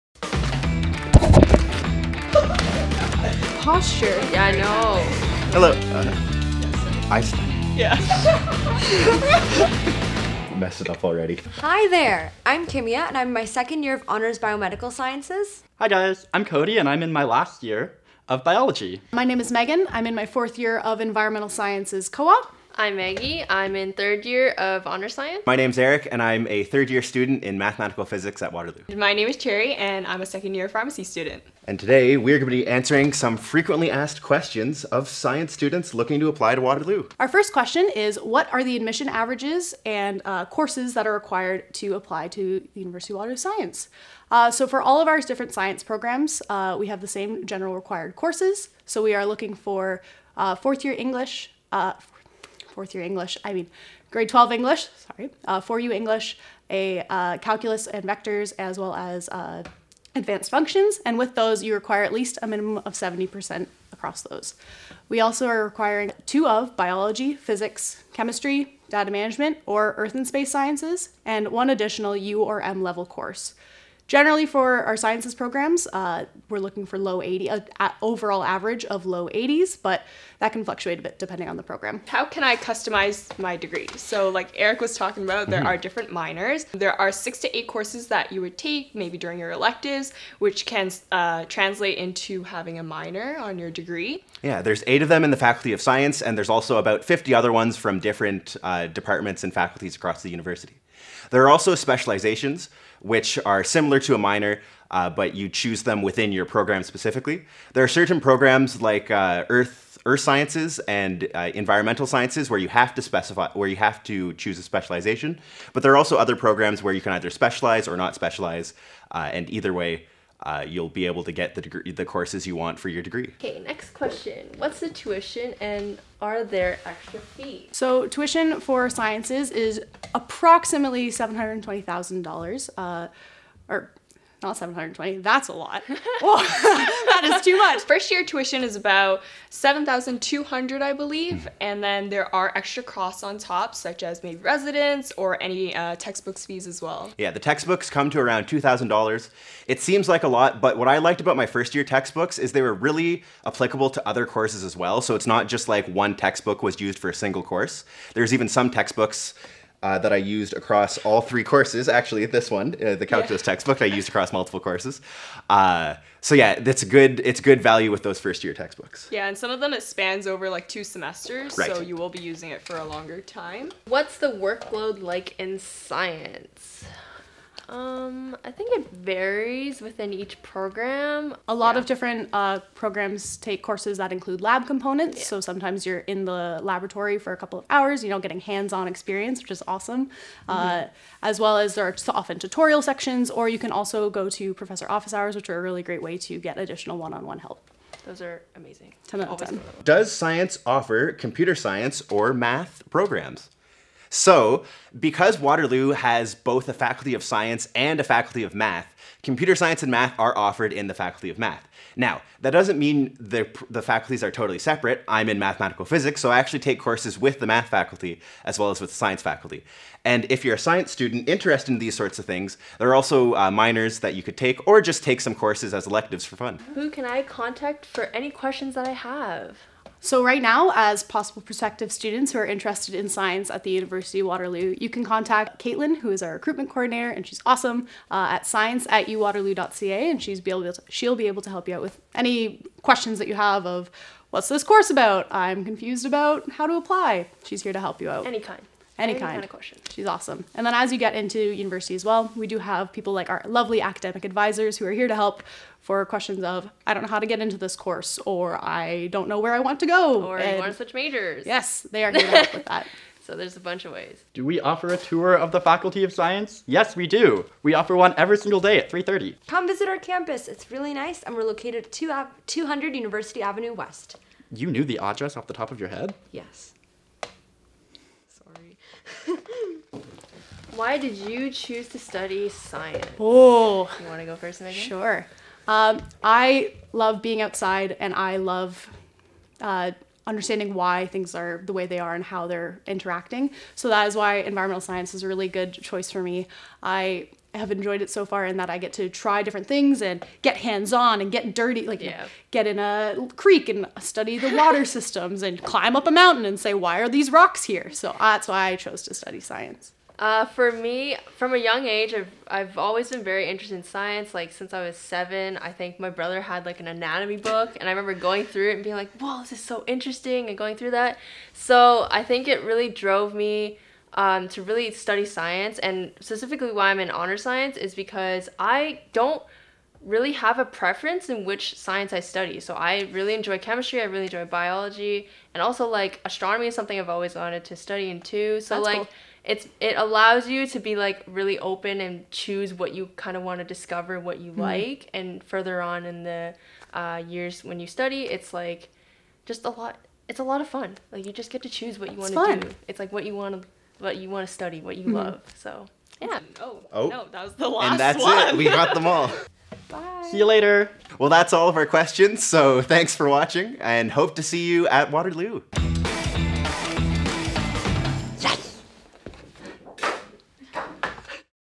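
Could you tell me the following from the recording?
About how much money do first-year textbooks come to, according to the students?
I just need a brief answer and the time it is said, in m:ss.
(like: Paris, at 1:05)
$2,000, at 2:28.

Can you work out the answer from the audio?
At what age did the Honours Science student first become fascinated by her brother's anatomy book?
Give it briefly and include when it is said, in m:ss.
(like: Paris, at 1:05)
7, at 5:14.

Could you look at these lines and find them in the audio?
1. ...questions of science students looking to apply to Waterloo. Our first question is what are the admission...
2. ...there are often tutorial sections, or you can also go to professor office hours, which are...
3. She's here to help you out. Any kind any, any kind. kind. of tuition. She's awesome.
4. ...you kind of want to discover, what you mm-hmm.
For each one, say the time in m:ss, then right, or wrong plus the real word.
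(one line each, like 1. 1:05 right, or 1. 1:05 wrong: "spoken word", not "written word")
1. 0:34 right
2. 3:11 right
3. 4:07 wrong: "question", not "tuition"
4. 5:42 right.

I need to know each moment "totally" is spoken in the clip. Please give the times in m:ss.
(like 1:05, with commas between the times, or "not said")
3:34.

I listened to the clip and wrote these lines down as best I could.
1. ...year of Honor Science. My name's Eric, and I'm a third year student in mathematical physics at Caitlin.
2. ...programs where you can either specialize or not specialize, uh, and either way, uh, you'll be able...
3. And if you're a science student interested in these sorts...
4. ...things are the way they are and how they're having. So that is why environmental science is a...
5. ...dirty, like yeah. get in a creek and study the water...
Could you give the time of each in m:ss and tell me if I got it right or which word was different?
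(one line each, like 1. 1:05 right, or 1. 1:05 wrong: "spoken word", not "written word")
1. 0:24 wrong: "Waterloo", not "Caitlin"
2. 1:56 right
3. 3:40 right
4. 4:51 wrong: "interacting", not "having"
5. 5:01 right.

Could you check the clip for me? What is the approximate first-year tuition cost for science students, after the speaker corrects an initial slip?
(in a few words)
7,200.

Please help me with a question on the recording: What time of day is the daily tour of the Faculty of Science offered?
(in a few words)
3:30.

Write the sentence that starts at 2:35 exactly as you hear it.
So it's not just like one textbook was used for a single course.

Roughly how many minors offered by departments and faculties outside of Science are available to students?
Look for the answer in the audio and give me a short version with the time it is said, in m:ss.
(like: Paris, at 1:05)
about 50, at 1:36.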